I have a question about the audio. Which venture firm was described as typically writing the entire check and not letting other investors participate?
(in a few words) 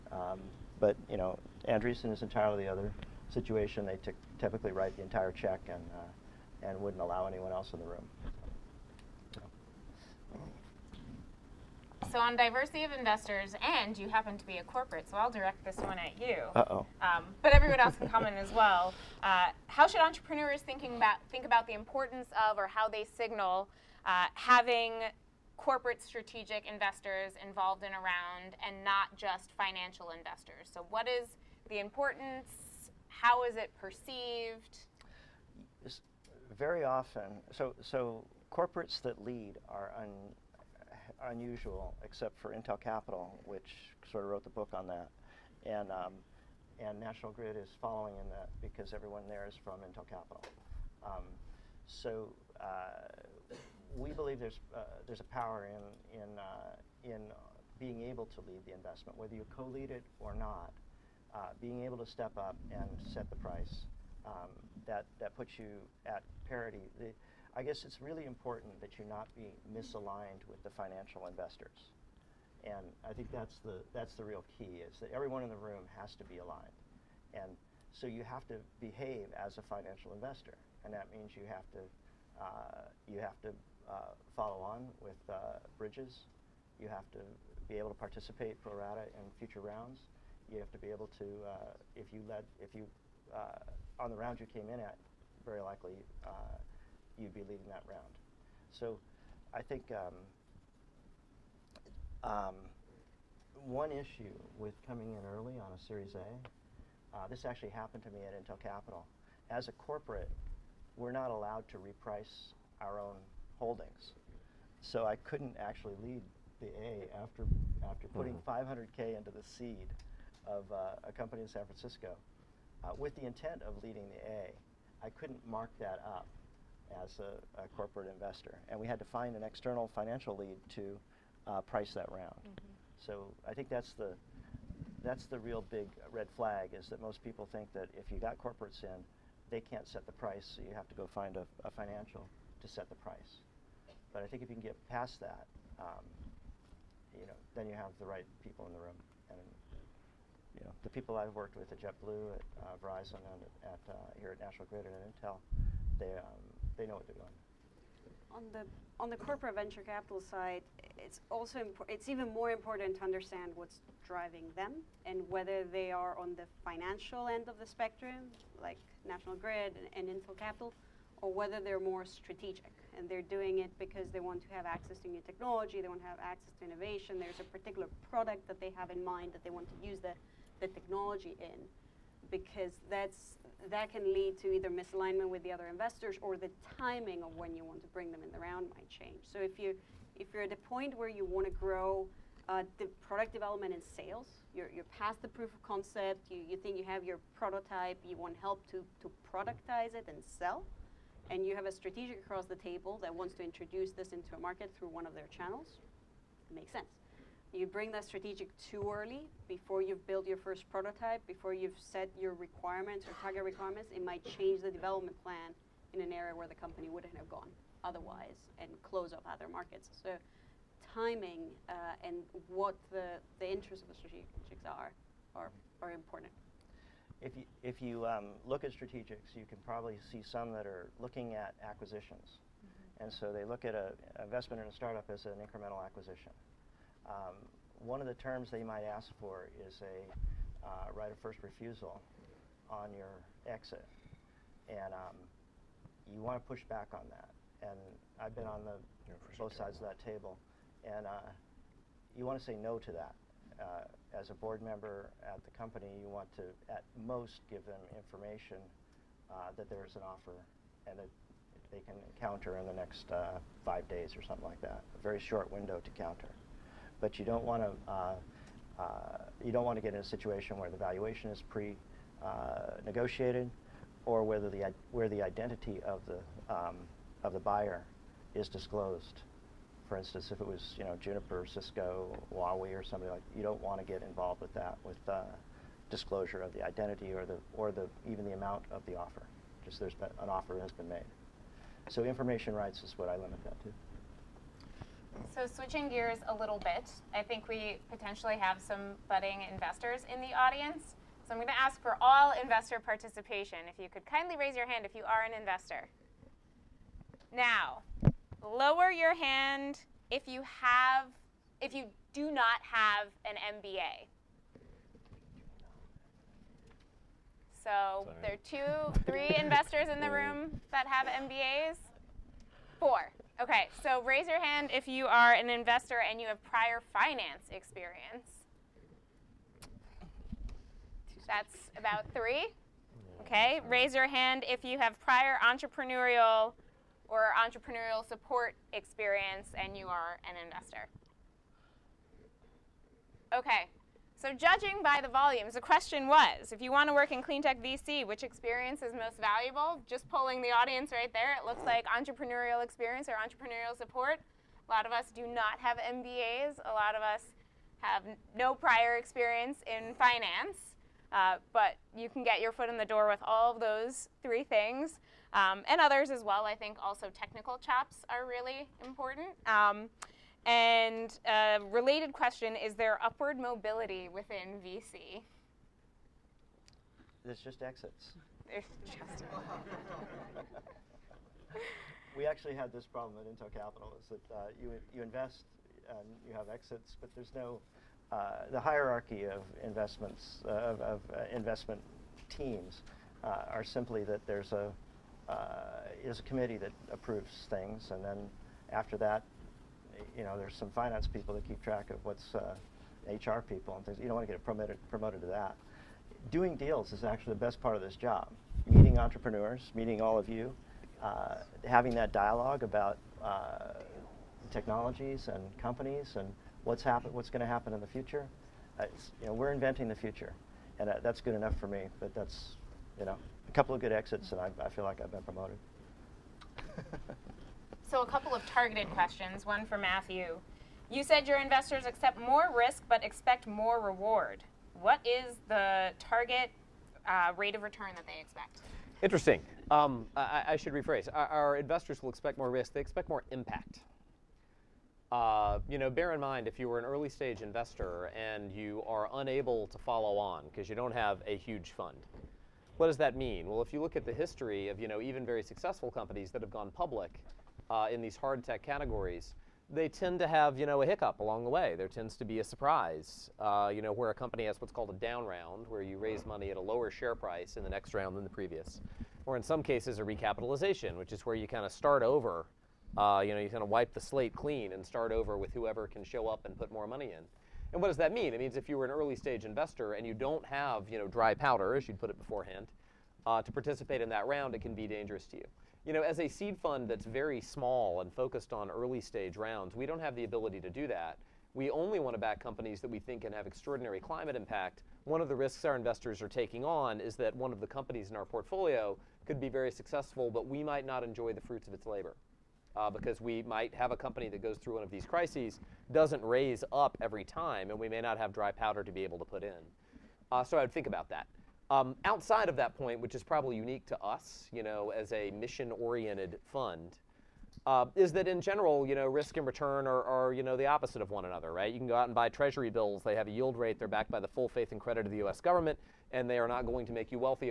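Andreessen.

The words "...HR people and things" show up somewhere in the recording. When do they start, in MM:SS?
06:43.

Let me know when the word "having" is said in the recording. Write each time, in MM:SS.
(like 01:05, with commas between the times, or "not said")
00:24, 06:51.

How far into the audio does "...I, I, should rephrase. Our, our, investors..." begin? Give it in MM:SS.
07:20.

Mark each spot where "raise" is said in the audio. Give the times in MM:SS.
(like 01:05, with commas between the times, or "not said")
05:04, 05:24, 05:33, 07:45, 08:26.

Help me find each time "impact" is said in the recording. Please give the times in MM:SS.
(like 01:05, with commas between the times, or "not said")
07:23, 08:14.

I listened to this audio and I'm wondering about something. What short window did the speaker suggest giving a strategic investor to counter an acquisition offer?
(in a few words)
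5 days.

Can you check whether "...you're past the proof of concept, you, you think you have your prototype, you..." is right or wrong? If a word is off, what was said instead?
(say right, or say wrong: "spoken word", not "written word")
right.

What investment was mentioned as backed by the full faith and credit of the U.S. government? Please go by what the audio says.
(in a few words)
treasury bills.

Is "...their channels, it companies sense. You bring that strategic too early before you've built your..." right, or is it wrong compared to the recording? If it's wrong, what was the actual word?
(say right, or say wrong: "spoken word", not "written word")
wrong: "makes", not "companies".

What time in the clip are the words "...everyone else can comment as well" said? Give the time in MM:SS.
00:17.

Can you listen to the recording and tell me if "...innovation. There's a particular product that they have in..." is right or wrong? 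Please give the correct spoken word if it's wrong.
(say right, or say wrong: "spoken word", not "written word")
right.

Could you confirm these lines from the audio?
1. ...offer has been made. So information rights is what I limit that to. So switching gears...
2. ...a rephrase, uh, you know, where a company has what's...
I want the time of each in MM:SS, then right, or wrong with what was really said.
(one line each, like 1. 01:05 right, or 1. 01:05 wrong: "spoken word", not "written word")
1. 04:50 right
2. 07:42 wrong: "surprise", not "rephrase".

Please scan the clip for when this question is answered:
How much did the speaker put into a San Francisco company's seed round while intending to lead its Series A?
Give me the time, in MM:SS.
01:58.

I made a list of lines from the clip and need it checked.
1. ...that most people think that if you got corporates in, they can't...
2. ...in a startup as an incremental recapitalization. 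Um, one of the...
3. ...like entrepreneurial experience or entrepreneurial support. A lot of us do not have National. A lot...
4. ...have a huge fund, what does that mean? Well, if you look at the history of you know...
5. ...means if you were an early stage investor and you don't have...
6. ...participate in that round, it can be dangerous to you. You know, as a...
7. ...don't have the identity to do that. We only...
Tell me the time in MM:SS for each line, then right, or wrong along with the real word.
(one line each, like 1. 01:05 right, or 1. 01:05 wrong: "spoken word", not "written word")
1. 02:16 right
2. 03:54 wrong: "acquisition", not "recapitalization"
3. 05:51 wrong: "MBAs", not "National"
4. 07:30 right
5. 07:58 right
6. 08:03 right
7. 08:09 wrong: "ability", not "identity".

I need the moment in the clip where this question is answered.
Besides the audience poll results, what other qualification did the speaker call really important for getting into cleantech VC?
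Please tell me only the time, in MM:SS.
06:07.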